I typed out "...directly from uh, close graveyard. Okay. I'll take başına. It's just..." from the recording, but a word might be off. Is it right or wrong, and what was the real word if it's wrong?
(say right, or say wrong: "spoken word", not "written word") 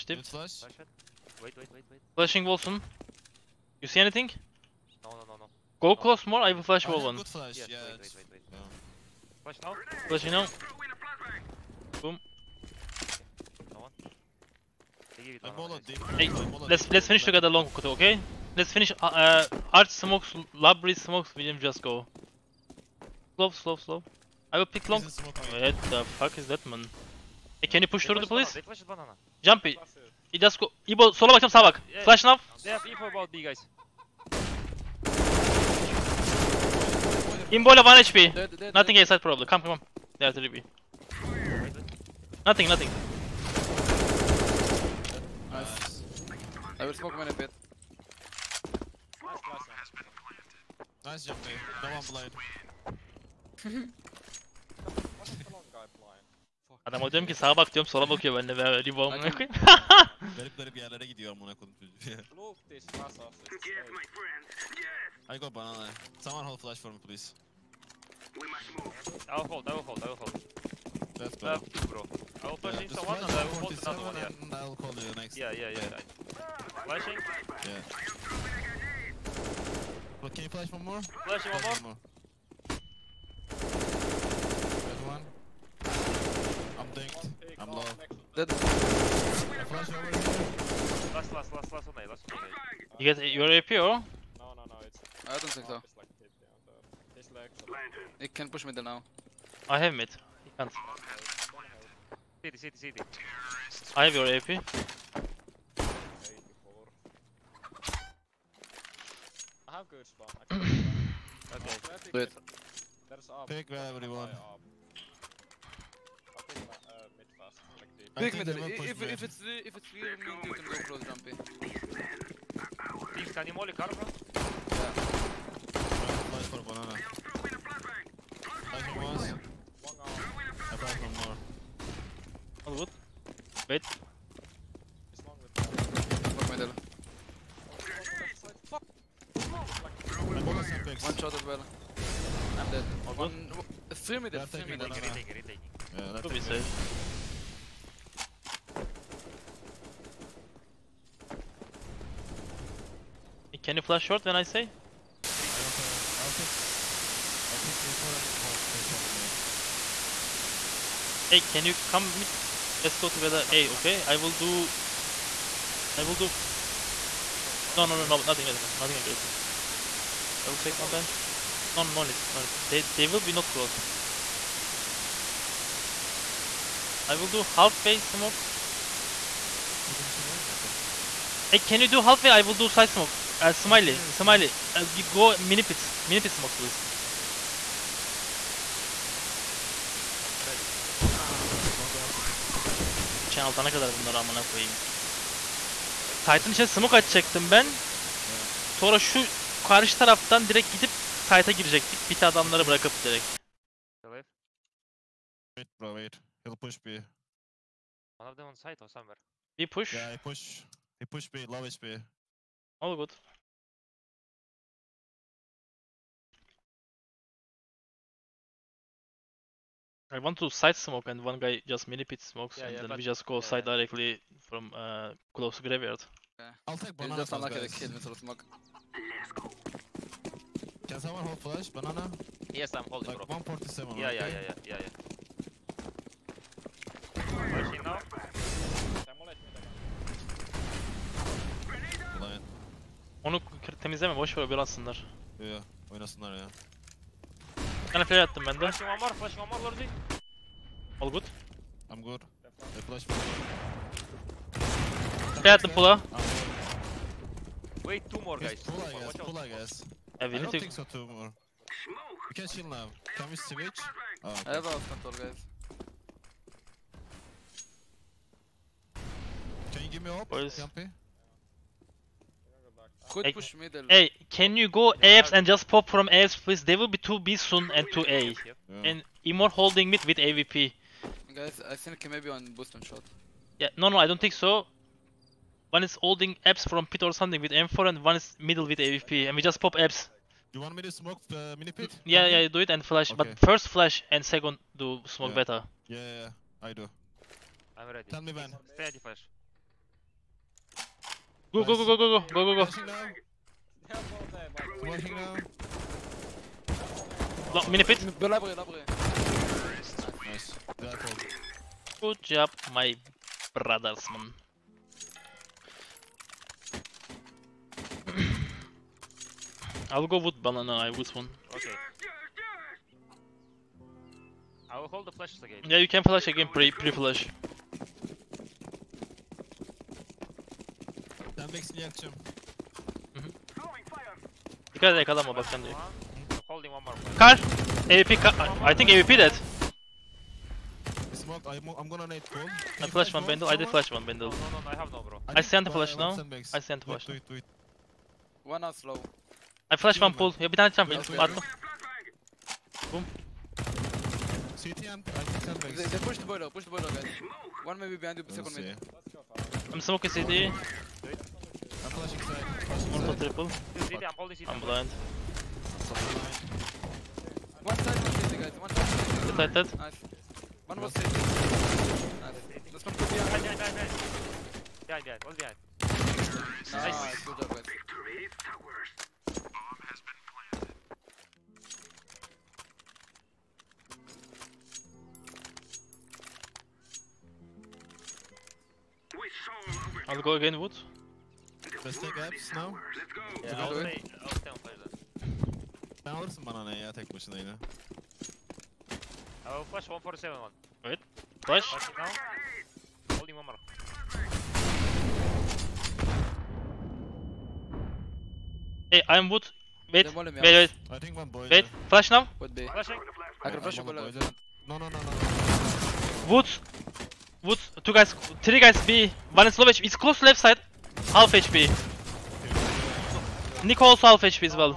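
wrong: "banana", not "başına".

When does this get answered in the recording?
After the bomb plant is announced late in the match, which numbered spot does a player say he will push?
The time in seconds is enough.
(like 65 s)
397 s.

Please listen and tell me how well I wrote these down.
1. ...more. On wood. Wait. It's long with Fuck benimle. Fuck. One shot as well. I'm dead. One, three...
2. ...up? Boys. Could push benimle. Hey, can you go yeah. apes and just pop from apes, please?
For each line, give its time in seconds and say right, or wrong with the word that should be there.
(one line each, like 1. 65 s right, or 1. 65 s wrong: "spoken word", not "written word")
1. 131 s wrong: "middle", not "benimle"
2. 270 s wrong: "middle", not "benimle".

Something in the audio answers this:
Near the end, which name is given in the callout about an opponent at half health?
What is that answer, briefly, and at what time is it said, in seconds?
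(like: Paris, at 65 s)
Nichols, at 423 s.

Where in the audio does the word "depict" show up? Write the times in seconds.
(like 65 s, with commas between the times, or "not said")
not said.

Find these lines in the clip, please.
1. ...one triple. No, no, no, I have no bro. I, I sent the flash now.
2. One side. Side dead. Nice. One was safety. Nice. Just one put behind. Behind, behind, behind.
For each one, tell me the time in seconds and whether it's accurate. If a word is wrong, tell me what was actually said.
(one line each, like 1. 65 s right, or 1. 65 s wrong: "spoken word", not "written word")
1. 343 s wrong: "bundle", not "triple"
2. 368 s right.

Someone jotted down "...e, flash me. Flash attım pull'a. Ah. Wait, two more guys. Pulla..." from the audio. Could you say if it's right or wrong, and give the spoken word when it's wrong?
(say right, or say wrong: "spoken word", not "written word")
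right.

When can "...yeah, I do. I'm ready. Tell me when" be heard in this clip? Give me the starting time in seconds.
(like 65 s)
295 s.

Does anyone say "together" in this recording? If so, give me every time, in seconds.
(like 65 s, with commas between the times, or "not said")
17 s, 163 s.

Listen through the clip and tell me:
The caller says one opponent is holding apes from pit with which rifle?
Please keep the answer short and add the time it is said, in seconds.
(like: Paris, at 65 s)
M4, at 287 s.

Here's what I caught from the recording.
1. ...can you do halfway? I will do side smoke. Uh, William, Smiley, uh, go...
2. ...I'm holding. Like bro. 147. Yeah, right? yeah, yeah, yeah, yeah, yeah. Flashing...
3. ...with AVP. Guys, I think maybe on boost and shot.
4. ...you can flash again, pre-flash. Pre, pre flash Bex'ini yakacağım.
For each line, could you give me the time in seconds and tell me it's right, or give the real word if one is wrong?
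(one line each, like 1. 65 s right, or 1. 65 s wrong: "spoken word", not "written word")
1. 181 s wrong: "Smiley", not "William"
2. 232 s right
3. 280 s right
4. 325 s right.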